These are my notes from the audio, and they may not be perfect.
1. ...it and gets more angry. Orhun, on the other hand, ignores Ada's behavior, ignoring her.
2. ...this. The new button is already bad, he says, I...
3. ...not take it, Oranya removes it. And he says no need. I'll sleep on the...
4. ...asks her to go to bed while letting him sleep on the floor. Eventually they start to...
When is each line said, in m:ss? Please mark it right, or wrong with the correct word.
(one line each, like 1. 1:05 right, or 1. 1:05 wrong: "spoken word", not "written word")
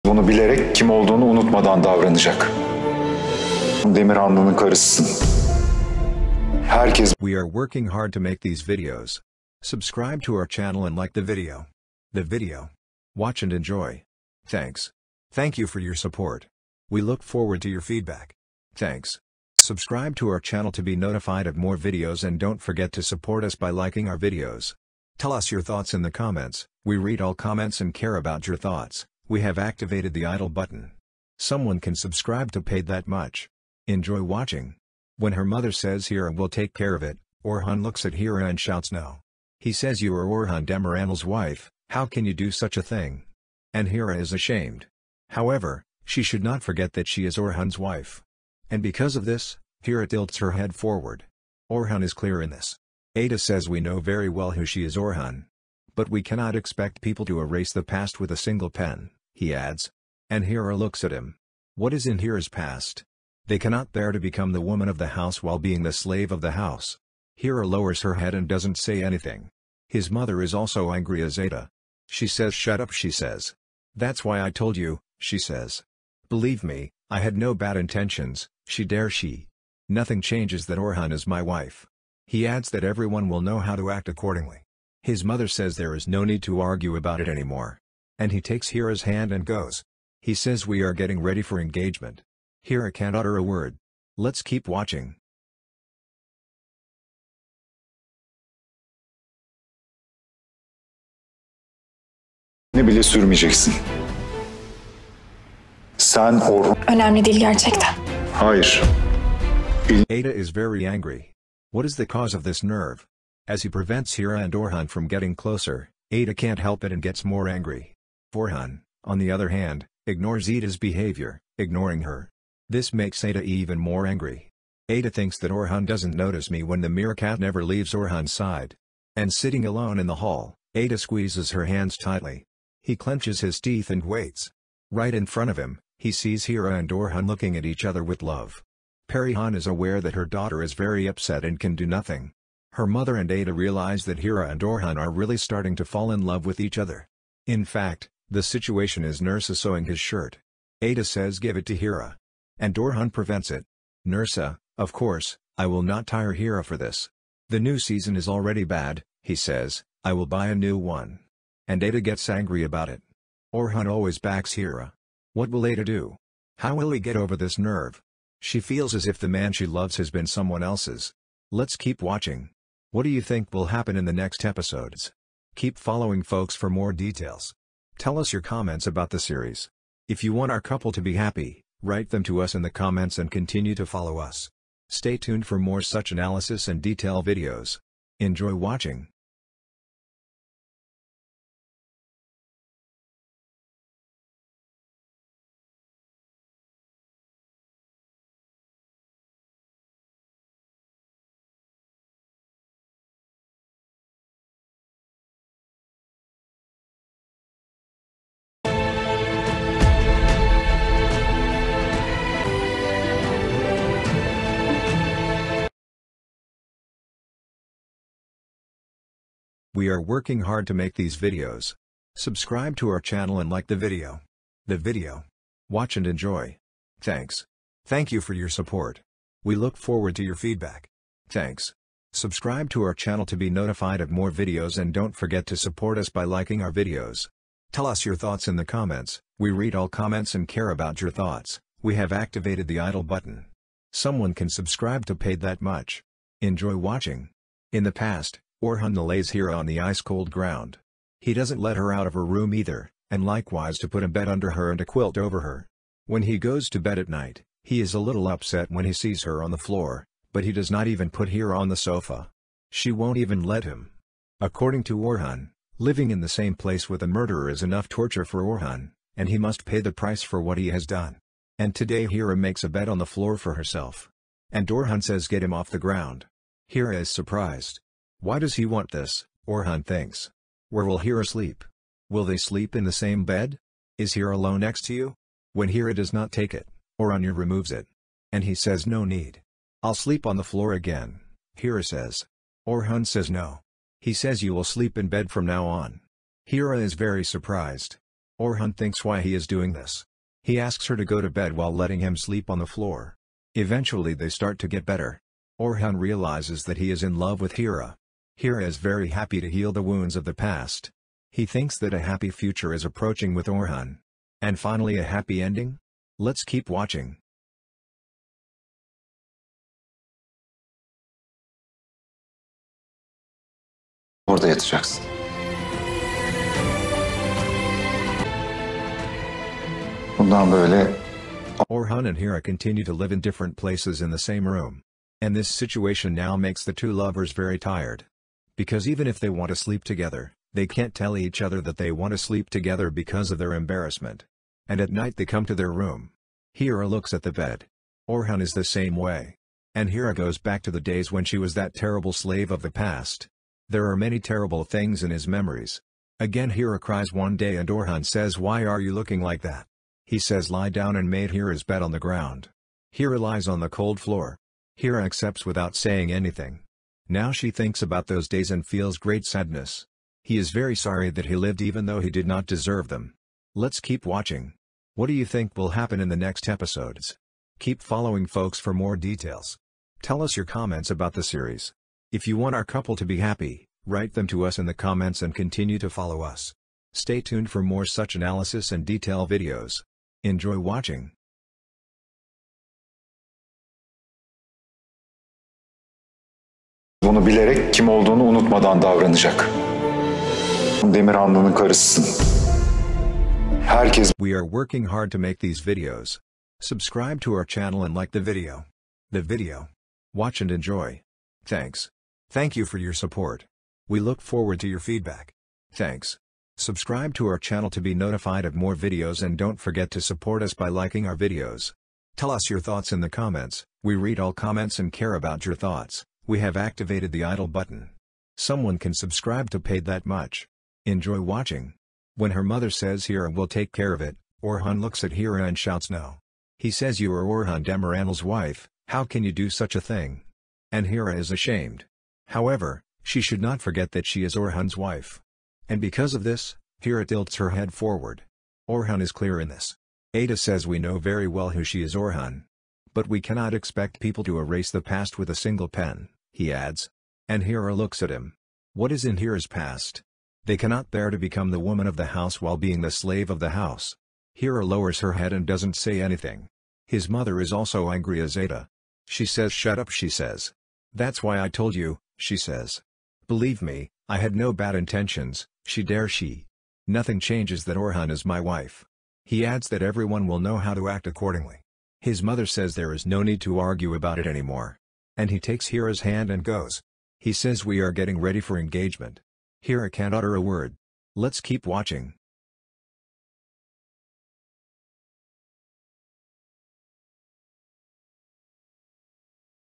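1. 1:56 right
2. 2:36 wrong: "season", not "button"
3. 4:46 right
4. 5:00 right.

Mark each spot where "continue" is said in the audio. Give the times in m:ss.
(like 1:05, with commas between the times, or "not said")
3:03, 5:32, 6:25.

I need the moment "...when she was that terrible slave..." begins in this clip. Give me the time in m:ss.
5:51.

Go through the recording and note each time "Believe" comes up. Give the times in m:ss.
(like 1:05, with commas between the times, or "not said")
1:16, 7:53.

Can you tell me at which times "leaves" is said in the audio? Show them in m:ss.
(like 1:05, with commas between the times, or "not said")
2:07.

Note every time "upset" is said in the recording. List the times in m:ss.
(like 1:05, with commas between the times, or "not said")
2:21, 4:18.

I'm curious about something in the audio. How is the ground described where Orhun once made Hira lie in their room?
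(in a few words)
ice-cold ground.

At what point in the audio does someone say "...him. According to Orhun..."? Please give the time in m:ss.
4:23.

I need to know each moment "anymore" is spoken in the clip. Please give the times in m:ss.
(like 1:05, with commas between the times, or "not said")
1:27, 8:04.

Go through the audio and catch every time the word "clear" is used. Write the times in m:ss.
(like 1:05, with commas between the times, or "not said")
0:52, 7:29.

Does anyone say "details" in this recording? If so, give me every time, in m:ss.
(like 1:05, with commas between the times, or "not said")
2:56, 3:06, 6:18, 6:28.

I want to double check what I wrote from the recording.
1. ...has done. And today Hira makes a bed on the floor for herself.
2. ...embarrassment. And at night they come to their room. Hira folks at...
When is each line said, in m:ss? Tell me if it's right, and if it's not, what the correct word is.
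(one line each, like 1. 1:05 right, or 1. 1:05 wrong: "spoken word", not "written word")
1. 4:30 right
2. 5:43 wrong: "looks", not "folks".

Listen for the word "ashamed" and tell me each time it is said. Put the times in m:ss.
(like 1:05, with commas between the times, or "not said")
0:44, 7:21.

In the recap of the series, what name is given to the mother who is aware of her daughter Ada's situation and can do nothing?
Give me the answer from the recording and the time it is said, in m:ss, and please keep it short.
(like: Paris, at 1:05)
Perihan, at 2:19.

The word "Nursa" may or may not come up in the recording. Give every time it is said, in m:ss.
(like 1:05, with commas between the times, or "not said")
2:29, 2:34.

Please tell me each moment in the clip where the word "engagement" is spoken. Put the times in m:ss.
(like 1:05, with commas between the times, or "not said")
1:31, 8:08.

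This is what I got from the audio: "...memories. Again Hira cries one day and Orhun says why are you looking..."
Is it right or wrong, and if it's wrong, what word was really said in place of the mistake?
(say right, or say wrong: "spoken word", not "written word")
right.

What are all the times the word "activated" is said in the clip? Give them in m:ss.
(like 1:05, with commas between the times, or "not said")
0:29, 4:02, 7:06.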